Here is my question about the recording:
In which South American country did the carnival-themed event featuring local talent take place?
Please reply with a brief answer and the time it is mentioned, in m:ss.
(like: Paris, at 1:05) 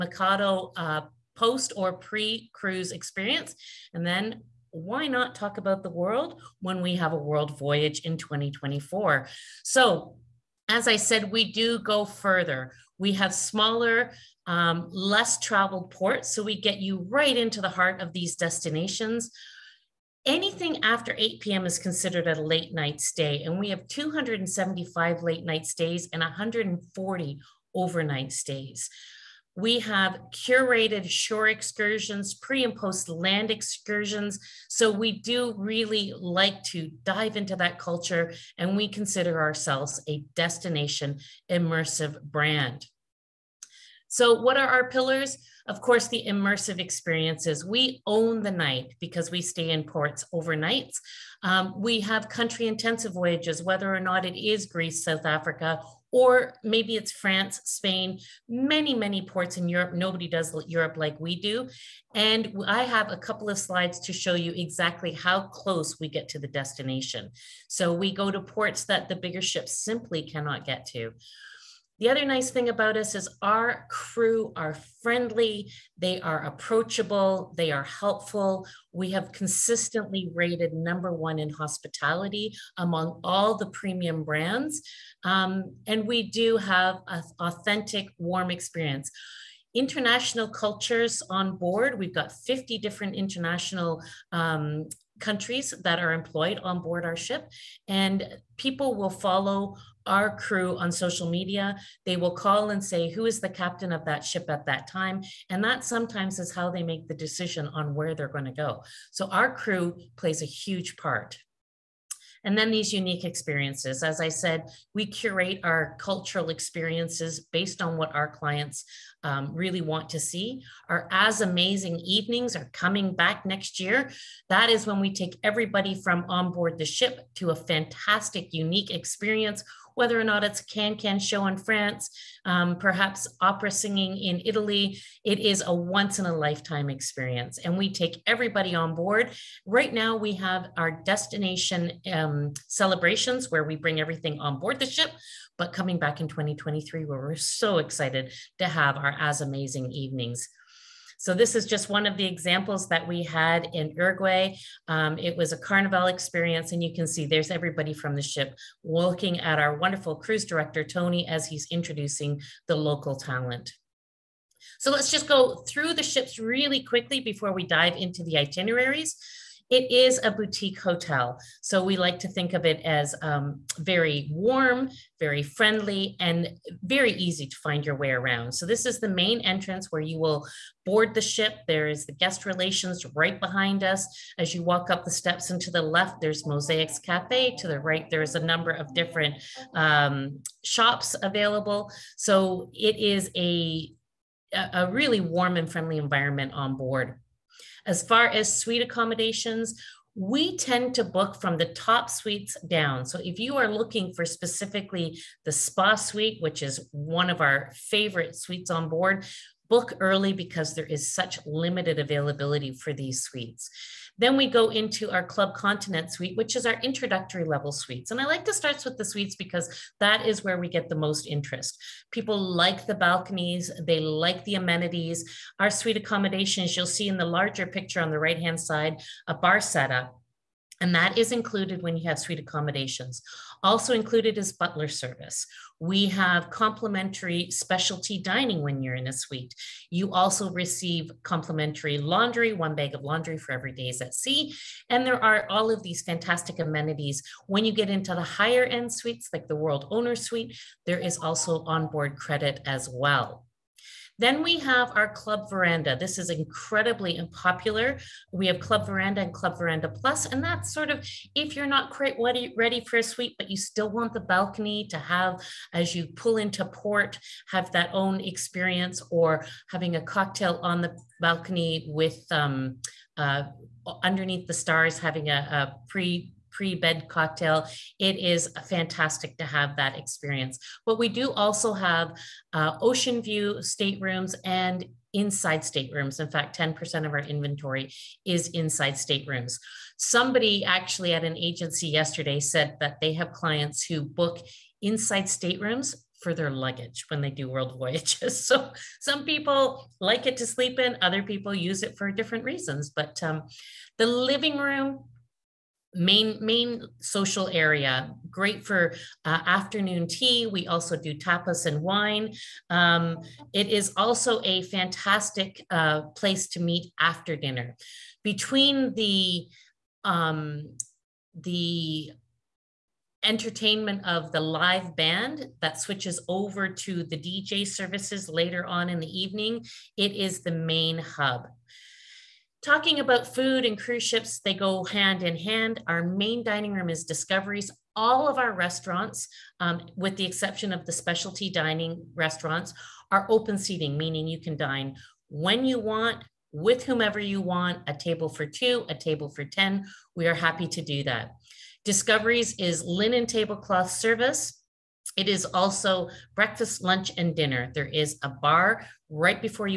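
Uruguay, at 2:33.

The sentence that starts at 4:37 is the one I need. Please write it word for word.
It is fantastic to have that experience.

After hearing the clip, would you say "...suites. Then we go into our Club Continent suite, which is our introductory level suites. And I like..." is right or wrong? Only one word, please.
right.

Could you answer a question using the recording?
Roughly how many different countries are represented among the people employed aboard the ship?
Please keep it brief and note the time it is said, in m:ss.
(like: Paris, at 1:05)
50, at 1:32.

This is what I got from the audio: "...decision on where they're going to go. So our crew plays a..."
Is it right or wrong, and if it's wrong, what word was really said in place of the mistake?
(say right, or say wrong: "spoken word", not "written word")
right.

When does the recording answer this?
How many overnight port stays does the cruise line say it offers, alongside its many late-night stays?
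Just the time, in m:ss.
0:26.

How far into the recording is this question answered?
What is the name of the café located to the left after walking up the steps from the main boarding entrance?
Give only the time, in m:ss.
3:06.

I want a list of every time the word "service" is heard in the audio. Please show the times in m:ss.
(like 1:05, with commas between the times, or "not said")
3:54, 5:27, 5:53.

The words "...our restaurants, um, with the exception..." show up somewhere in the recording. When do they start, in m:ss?
5:38.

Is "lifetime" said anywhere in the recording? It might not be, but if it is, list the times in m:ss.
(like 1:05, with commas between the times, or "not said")
2:16.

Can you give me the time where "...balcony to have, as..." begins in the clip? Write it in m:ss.
4:24.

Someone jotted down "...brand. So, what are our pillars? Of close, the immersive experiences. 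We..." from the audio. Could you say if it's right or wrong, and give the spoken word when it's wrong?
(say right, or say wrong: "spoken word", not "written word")
wrong: "course", not "close".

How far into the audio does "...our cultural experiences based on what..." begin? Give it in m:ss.
1:55.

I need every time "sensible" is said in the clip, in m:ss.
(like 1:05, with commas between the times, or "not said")
not said.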